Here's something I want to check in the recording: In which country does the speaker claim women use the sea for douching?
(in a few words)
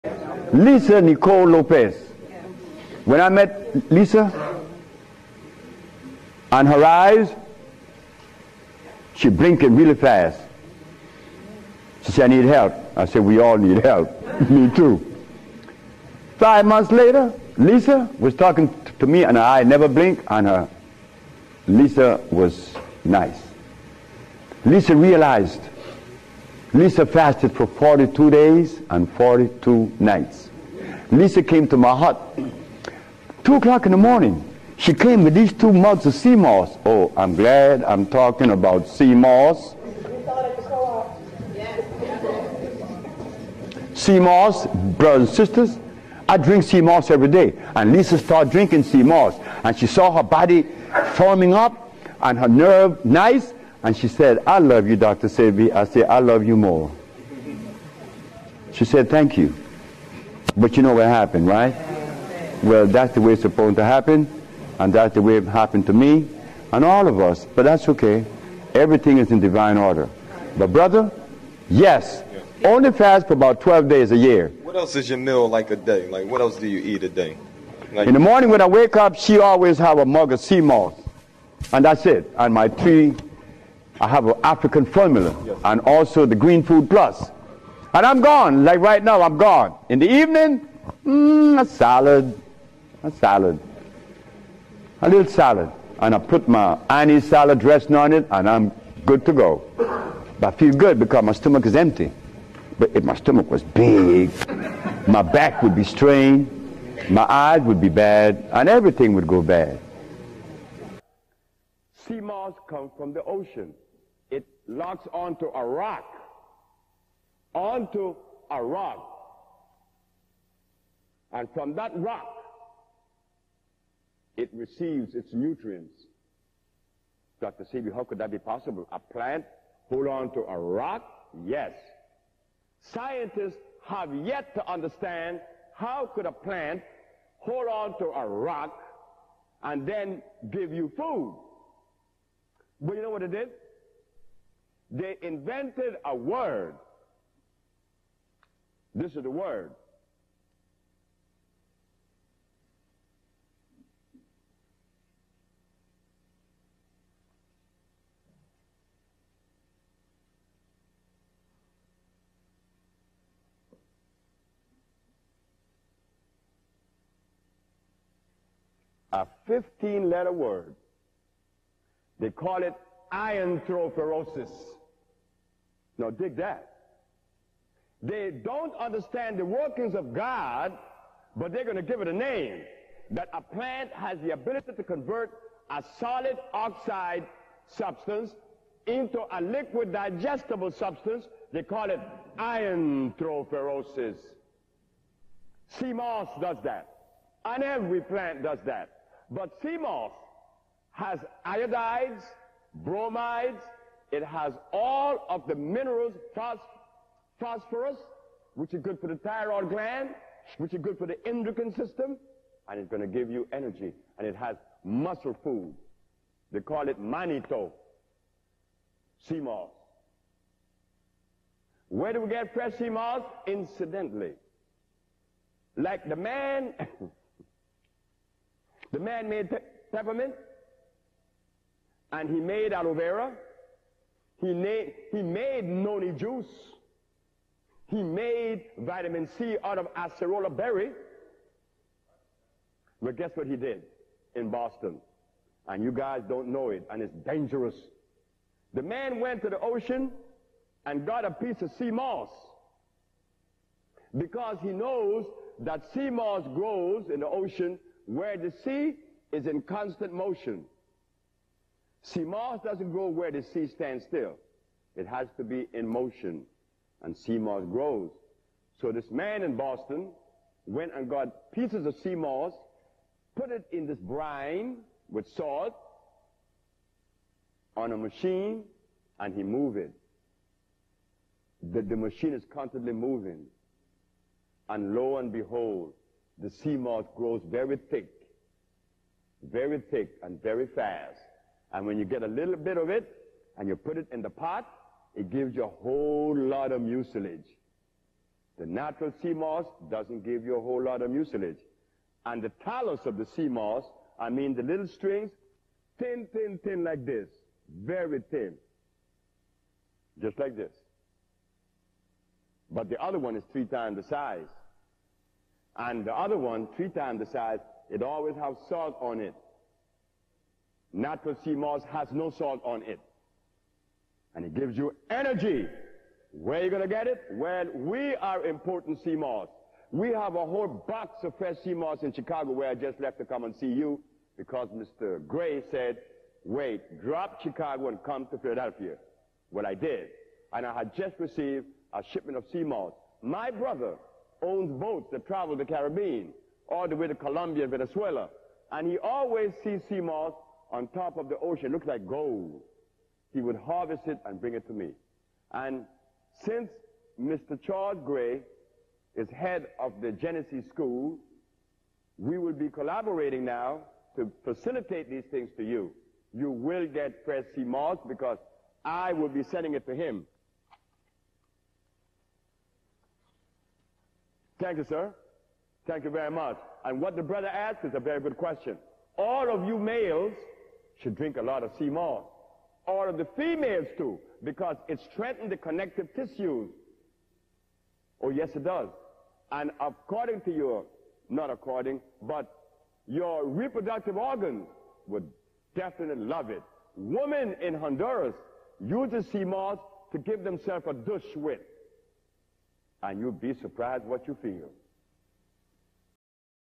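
Honduras.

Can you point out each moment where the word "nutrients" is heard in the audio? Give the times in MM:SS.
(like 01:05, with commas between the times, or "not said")
02:05.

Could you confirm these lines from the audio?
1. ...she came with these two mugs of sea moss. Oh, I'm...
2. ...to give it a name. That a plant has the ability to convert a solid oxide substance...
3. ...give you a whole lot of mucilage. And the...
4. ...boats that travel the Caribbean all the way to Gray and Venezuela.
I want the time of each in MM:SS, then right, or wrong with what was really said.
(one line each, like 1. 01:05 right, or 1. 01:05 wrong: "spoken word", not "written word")
1. 00:34 right
2. 03:01 right
3. 05:00 right
4. 05:44 wrong: "Colombia", not "Gray".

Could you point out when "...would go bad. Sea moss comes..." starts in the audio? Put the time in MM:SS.
01:49.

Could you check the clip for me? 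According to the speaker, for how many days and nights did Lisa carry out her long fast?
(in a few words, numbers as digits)
42.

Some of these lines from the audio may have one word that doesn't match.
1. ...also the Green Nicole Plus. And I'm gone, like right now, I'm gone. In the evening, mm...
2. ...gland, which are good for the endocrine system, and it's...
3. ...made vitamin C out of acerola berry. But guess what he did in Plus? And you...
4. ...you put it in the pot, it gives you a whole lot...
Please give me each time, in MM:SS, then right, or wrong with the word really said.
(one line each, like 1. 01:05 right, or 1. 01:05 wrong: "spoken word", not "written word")
1. 01:25 wrong: "Food", not "Nicole"
2. 03:29 right
3. 03:58 wrong: "Boston", not "Plus"
4. 04:53 right.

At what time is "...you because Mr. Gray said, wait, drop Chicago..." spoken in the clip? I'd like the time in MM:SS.
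05:33.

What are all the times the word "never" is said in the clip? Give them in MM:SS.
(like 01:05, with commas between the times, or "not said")
00:19.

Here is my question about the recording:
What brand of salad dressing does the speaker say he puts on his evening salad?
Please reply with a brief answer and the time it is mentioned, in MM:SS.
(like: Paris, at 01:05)
Annie's, at 01:36.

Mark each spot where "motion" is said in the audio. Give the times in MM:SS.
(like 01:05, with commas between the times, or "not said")
04:20, 04:25.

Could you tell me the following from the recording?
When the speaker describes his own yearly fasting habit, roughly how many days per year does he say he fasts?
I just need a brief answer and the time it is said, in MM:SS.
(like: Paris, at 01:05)
12, at 01:13.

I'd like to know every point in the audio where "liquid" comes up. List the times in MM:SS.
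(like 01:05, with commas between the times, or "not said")
03:09.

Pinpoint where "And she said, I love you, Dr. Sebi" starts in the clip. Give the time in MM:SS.
00:53.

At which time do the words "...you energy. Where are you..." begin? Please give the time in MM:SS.
05:24.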